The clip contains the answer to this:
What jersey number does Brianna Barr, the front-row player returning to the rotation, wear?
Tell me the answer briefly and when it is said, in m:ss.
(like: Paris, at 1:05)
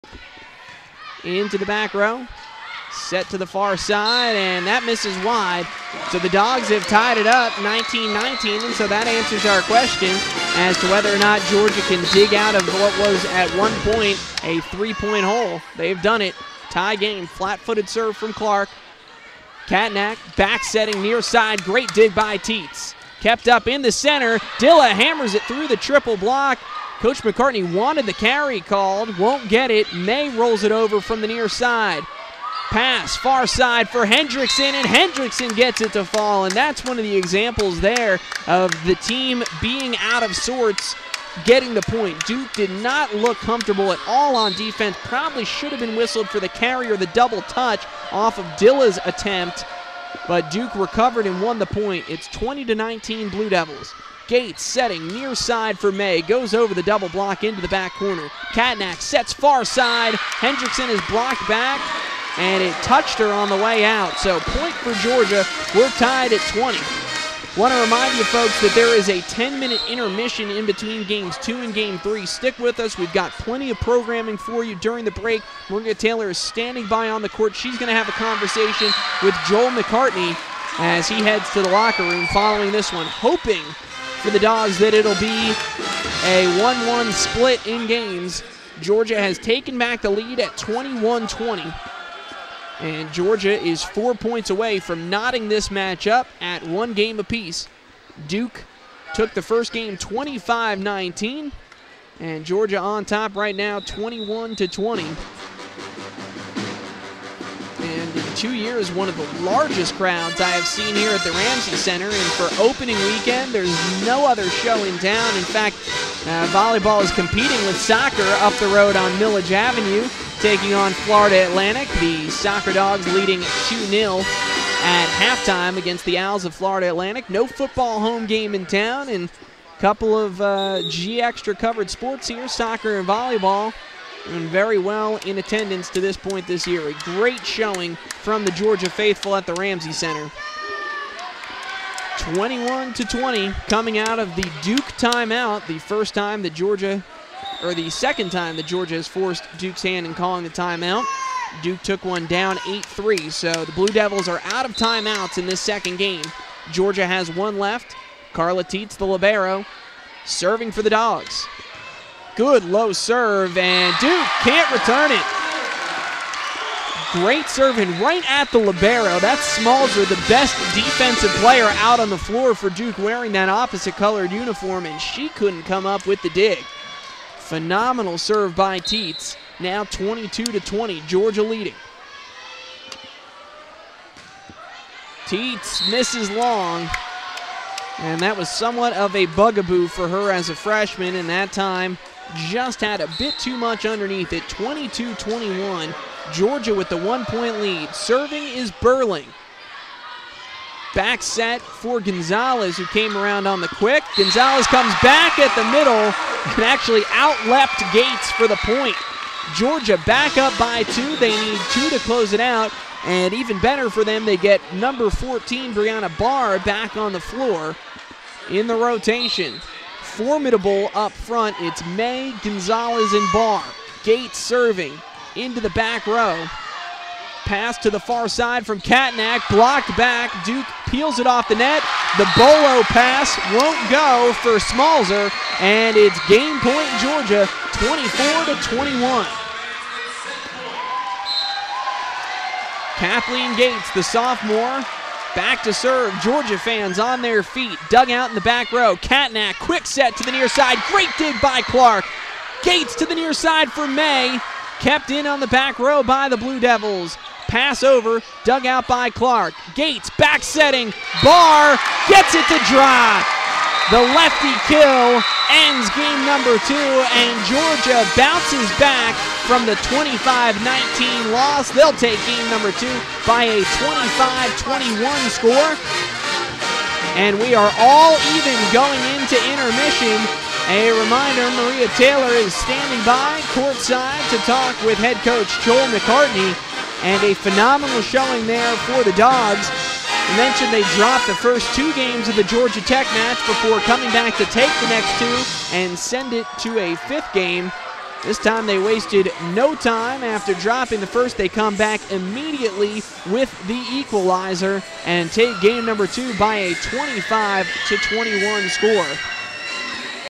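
14, at 3:34.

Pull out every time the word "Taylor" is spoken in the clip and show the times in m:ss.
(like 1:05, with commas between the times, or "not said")
1:15, 4:41.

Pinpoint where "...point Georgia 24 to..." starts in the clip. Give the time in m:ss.
3:56.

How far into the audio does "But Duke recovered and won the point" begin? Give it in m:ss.
0:50.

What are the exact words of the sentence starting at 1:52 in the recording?
And for opening weekend, there's no other show in town.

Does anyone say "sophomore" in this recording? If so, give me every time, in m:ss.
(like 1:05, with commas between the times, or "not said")
4:04.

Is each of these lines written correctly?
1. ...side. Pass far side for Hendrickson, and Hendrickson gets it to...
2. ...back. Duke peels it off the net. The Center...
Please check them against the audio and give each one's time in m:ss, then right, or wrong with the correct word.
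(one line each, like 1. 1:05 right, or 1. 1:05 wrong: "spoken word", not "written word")
1. 0:31 right
2. 3:49 wrong: "Bolo", not "Center".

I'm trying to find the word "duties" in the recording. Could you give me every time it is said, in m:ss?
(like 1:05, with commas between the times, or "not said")
not said.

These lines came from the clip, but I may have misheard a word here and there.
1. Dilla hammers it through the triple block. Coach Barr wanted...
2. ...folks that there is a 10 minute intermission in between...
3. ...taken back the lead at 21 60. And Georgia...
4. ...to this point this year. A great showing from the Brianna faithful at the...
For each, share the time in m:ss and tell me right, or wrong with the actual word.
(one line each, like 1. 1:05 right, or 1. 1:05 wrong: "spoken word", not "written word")
1. 0:24 wrong: "McCartney", not "Barr"
2. 1:08 right
3. 1:29 wrong: "20", not "60"
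4. 2:15 wrong: "Georgia", not "Brianna".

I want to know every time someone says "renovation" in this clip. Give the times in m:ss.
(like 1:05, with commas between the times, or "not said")
not said.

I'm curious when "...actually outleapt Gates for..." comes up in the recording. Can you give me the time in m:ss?
3:26.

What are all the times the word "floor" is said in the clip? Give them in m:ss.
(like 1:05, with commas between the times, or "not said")
2:52, 3:37.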